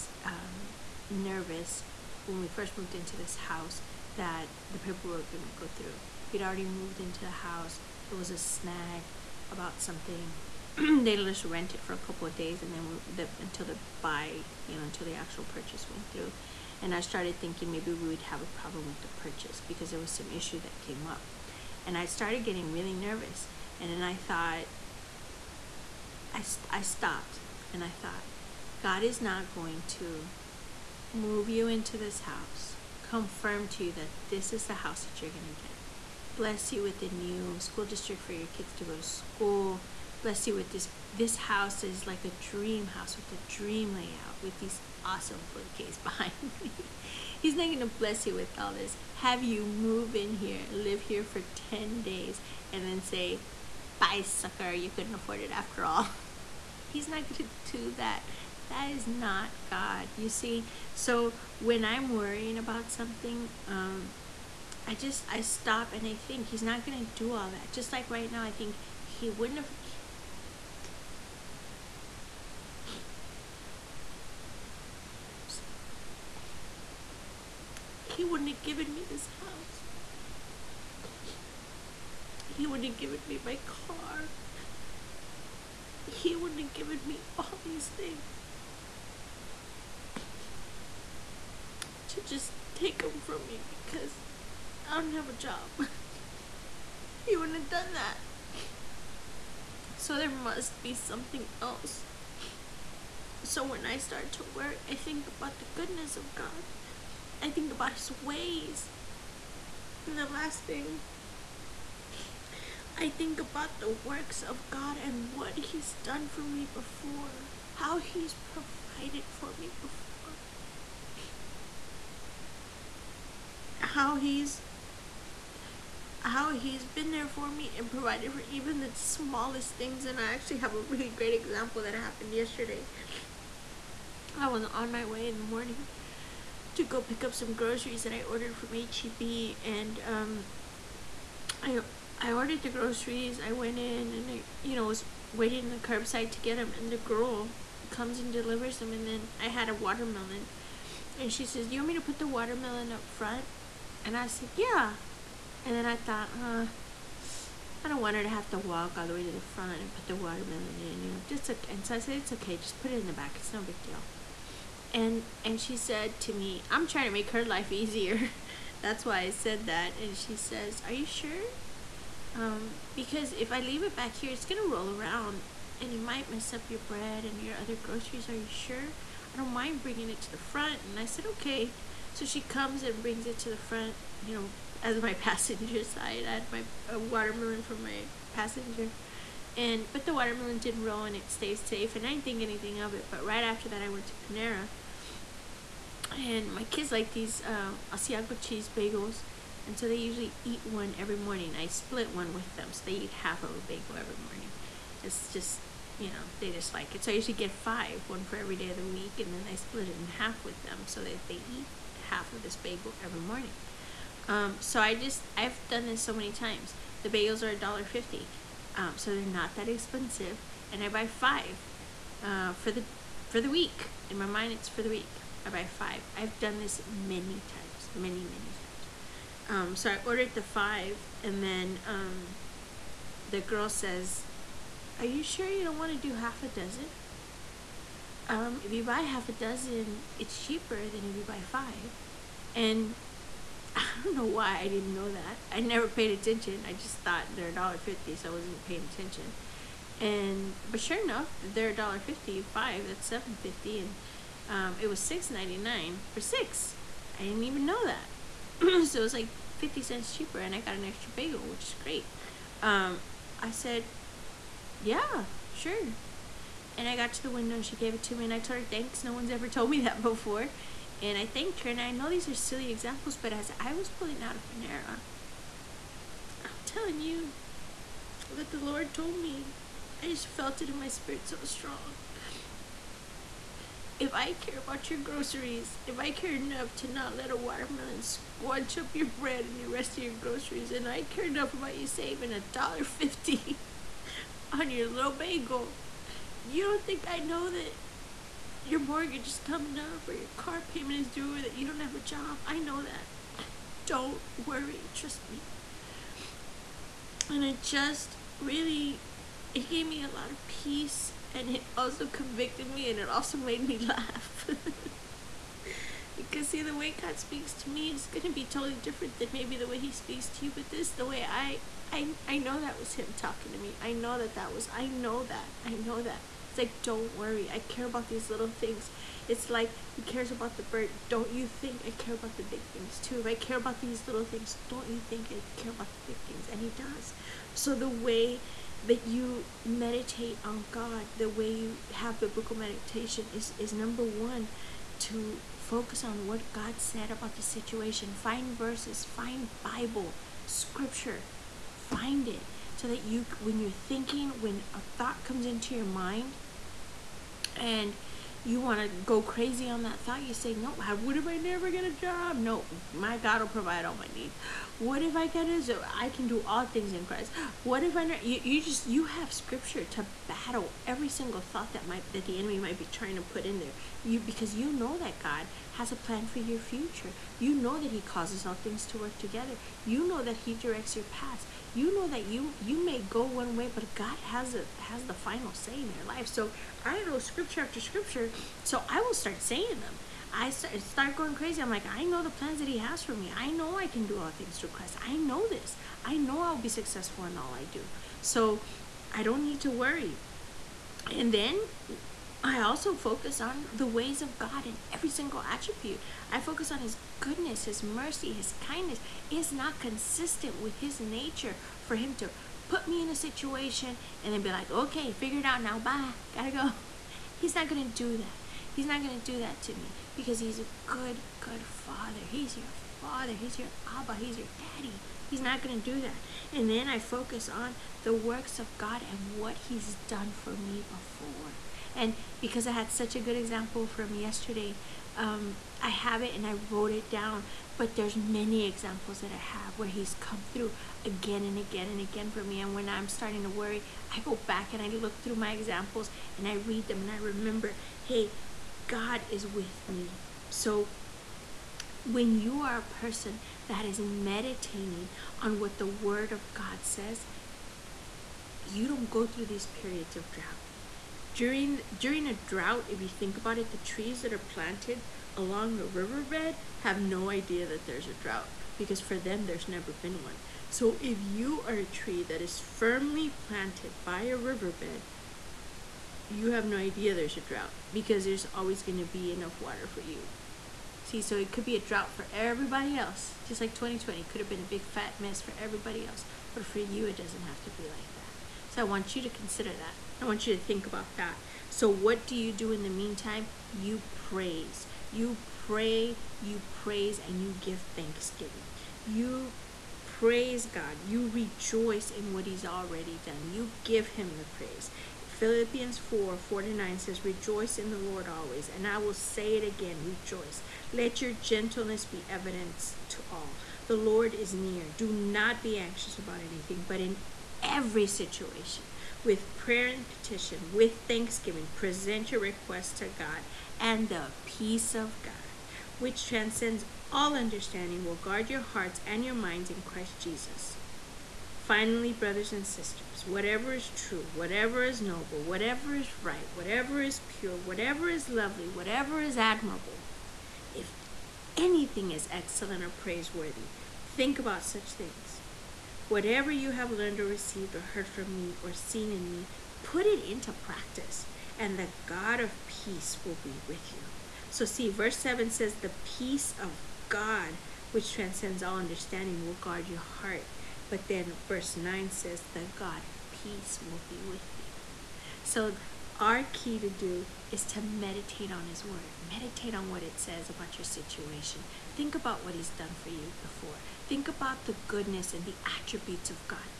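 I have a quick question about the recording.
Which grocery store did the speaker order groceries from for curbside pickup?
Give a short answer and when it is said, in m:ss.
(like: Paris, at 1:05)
HEB, at 2:18.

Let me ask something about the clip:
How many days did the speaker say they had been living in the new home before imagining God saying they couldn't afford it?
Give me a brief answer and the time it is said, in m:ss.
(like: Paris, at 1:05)
10, at 0:51.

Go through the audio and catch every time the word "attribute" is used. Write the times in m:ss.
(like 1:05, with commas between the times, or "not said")
6:45, 9:35.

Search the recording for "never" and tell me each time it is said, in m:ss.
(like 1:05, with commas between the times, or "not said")
4:05, 6:01, 7:49.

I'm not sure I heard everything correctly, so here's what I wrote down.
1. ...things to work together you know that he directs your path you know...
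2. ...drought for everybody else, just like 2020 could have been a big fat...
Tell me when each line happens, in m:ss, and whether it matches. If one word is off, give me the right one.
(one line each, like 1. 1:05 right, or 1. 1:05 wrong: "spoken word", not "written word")
1. 6:18 right
2. 8:01 right.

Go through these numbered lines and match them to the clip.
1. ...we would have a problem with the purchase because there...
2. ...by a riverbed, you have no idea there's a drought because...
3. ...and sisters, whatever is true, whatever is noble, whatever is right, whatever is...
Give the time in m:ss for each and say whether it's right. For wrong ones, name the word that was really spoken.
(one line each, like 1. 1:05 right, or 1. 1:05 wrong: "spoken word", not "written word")
1. 0:17 right
2. 7:54 right
3. 8:52 right.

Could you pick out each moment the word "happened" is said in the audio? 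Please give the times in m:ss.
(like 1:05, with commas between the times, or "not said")
2:11.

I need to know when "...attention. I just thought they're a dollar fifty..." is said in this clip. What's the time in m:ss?
4:06.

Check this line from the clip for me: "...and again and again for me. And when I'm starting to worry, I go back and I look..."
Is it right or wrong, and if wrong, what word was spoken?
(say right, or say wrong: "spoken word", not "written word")
right.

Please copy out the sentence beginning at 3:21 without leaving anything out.
I split one with them so they eat half of a bagel every morning.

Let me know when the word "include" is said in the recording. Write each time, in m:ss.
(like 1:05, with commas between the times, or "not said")
not said.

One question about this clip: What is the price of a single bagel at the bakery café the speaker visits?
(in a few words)
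$1.50.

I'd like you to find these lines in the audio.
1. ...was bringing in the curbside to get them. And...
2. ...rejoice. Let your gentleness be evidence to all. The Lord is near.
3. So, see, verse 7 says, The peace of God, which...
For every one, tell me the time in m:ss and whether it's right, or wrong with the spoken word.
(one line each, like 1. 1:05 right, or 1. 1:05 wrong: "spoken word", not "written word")
1. 2:24 wrong: "waiting", not "bringing"
2. 8:30 right
3. 9:14 right.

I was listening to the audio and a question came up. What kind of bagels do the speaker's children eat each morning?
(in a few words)
Asiago cheese bagels.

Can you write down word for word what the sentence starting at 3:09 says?
And but the watermelon didn't roll and it stayed safe and I didn't think anything of it.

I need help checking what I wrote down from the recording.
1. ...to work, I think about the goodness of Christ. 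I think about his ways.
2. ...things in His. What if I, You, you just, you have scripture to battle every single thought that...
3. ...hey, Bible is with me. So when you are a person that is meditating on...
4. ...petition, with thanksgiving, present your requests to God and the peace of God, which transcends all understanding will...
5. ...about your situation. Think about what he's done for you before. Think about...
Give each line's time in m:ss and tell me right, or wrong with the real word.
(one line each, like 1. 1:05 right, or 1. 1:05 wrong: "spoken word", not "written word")
1. 1:44 wrong: "God", not "Christ"
2. 6:06 wrong: "Christ", not "His"
3. 7:27 wrong: "God", not "Bible"
4. 8:40 right
5. 9:30 right.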